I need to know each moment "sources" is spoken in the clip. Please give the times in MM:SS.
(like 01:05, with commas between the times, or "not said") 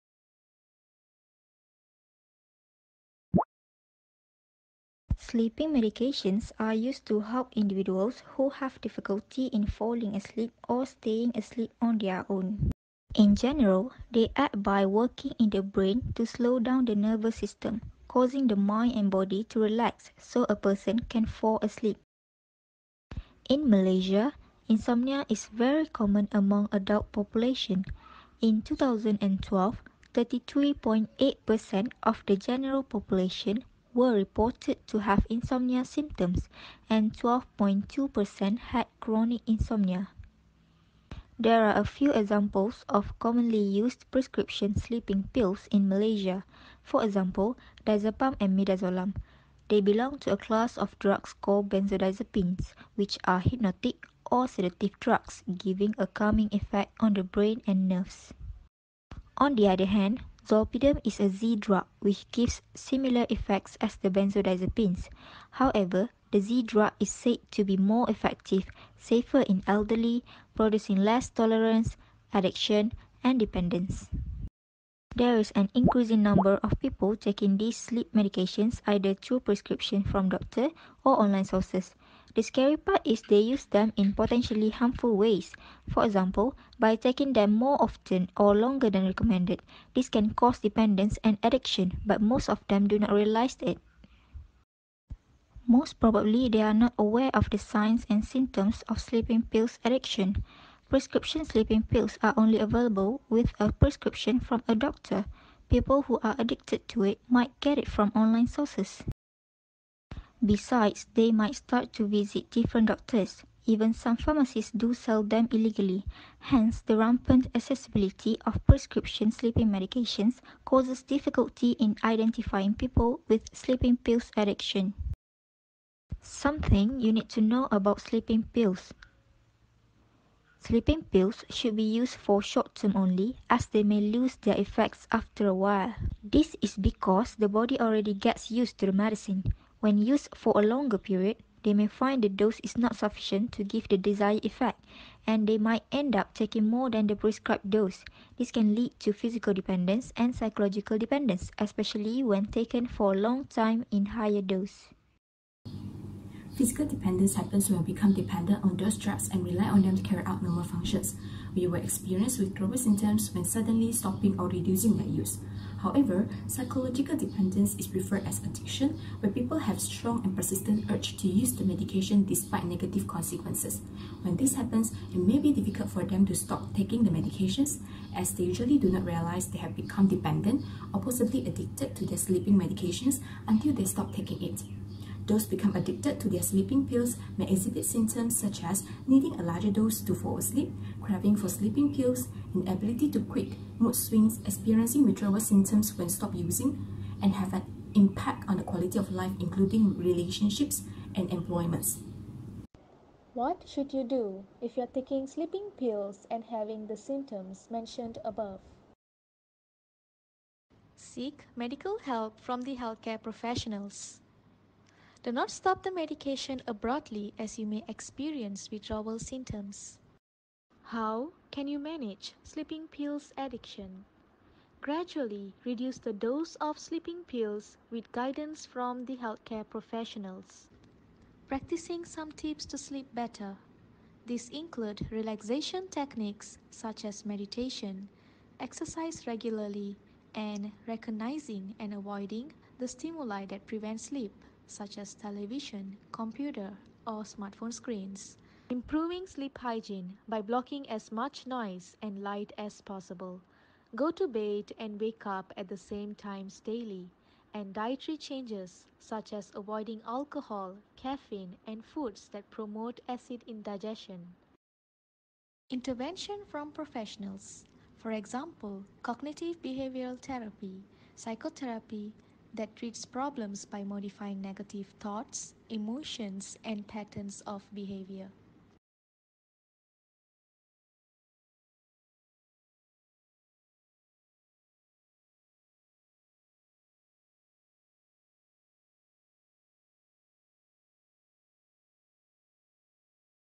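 01:21, 01:48.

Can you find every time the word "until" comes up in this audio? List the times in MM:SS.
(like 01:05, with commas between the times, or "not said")
03:03.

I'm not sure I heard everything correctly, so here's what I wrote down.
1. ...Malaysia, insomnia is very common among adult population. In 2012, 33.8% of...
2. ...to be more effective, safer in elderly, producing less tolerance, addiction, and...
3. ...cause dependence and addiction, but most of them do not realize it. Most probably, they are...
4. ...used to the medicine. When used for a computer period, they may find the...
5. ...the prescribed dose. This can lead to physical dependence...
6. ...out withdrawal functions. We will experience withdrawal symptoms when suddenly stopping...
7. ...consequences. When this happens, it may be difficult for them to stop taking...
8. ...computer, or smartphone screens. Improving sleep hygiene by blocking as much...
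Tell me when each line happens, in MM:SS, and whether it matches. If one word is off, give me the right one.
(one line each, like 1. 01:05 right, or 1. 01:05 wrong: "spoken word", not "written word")
1. 00:23 right
2. 01:07 right
3. 01:30 right
4. 02:18 wrong: "longer", not "computer"
5. 02:27 right
6. 02:40 wrong: "normal", not "withdrawal"
7. 02:53 right
8. 04:06 right.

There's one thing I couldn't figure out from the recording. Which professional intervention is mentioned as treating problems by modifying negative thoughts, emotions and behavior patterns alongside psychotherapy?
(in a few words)
Cognitive behavioral therapy.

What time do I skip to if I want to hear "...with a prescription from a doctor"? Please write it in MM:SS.
01:43.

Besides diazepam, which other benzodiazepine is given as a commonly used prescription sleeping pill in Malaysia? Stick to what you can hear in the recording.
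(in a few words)
Midazolam.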